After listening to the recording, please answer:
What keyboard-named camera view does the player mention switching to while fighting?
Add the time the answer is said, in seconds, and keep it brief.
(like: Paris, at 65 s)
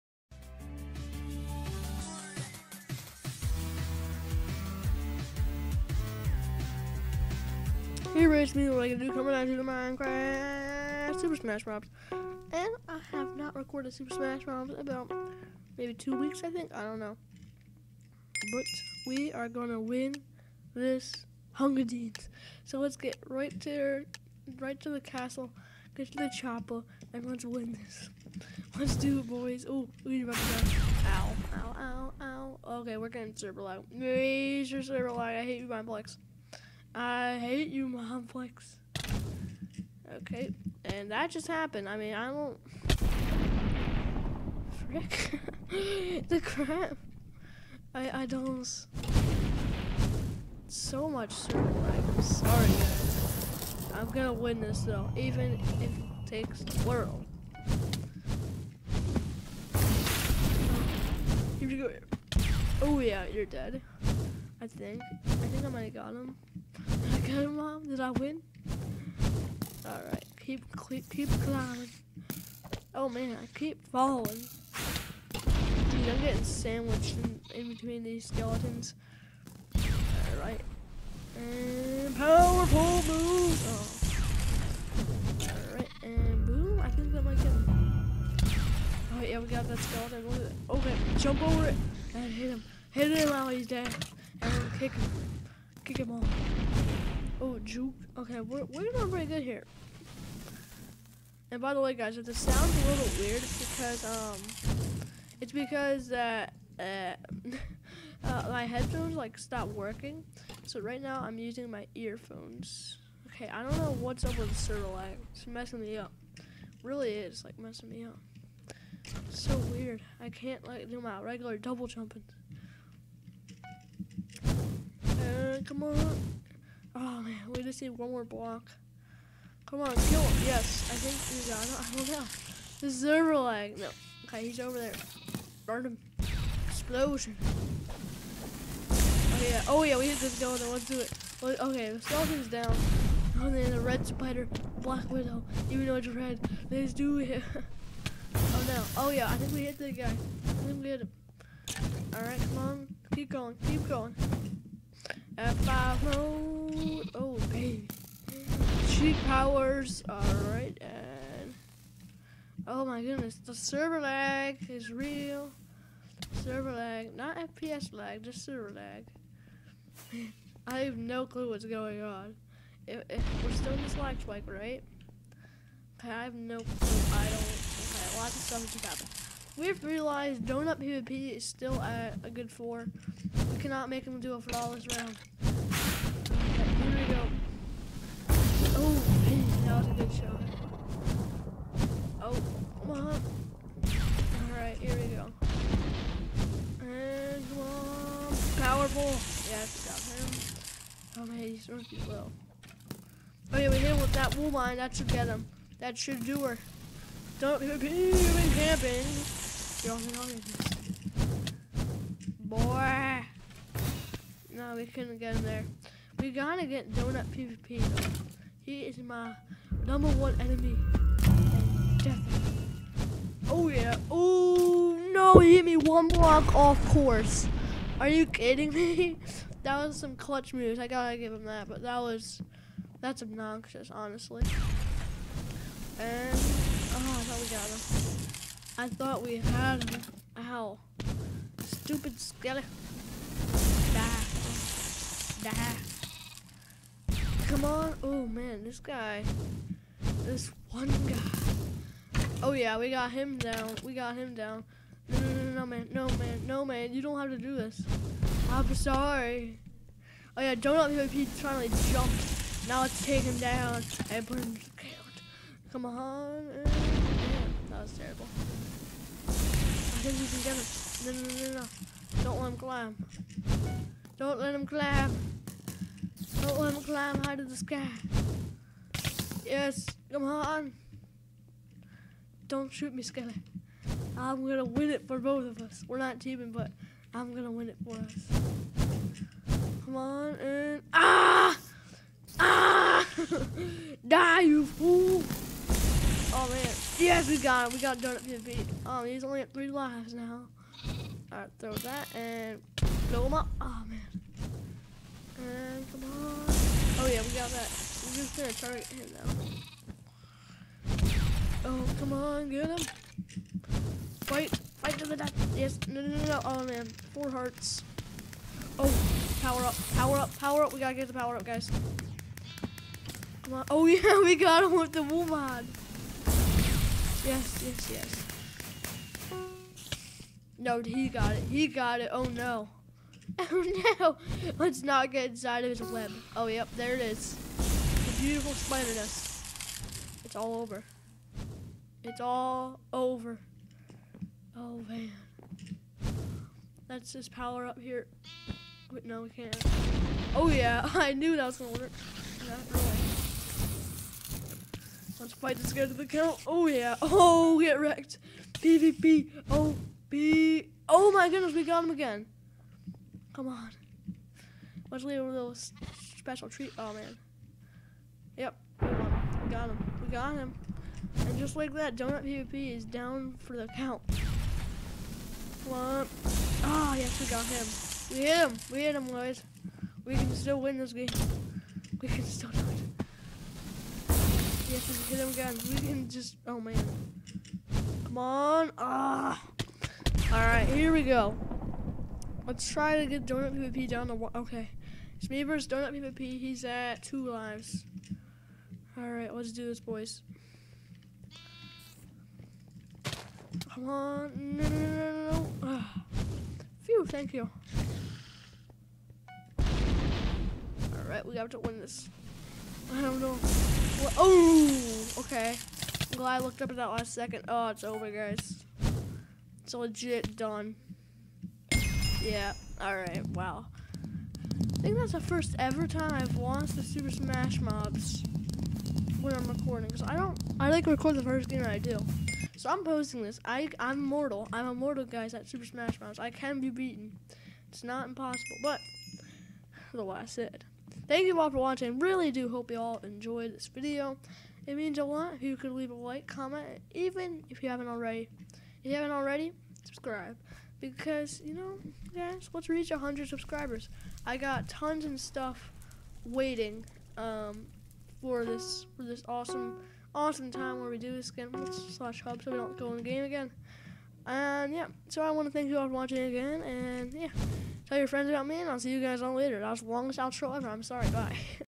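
F5 mode, at 155 s.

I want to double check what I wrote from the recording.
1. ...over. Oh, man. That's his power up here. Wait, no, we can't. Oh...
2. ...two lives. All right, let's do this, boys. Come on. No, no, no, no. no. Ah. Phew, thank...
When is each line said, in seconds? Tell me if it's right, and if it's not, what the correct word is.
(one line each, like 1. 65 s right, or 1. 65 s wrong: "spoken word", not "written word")
1. 342 s right
2. 397 s right.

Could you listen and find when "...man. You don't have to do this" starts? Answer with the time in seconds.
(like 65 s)
256 s.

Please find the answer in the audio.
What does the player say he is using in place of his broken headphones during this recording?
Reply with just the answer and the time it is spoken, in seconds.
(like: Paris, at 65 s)
Earphones, at 111 s.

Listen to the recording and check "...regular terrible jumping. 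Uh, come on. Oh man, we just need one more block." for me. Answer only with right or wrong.
wrong.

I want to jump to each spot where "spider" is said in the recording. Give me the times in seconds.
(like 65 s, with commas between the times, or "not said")
144 s, 338 s.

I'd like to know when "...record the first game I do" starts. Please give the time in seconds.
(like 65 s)
430 s.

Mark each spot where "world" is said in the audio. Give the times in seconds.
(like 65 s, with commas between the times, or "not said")
56 s.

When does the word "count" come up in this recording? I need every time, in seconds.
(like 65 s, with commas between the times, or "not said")
356 s, 373 s.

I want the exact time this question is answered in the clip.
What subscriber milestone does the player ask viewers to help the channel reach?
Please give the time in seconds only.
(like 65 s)
452 s.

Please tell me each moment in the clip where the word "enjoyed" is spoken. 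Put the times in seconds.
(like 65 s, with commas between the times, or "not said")
443 s.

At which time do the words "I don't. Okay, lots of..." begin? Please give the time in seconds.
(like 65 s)
177 s.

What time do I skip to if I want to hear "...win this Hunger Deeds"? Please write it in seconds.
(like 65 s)
19 s.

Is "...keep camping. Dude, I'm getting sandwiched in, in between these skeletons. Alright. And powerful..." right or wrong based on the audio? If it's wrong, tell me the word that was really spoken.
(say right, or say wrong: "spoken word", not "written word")
wrong: "falling", not "camping".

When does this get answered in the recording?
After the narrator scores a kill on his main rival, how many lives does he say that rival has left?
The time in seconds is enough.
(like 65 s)
299 s.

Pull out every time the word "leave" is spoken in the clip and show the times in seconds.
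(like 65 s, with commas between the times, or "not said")
365 s, 445 s.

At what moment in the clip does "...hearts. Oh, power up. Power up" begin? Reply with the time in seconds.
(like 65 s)
317 s.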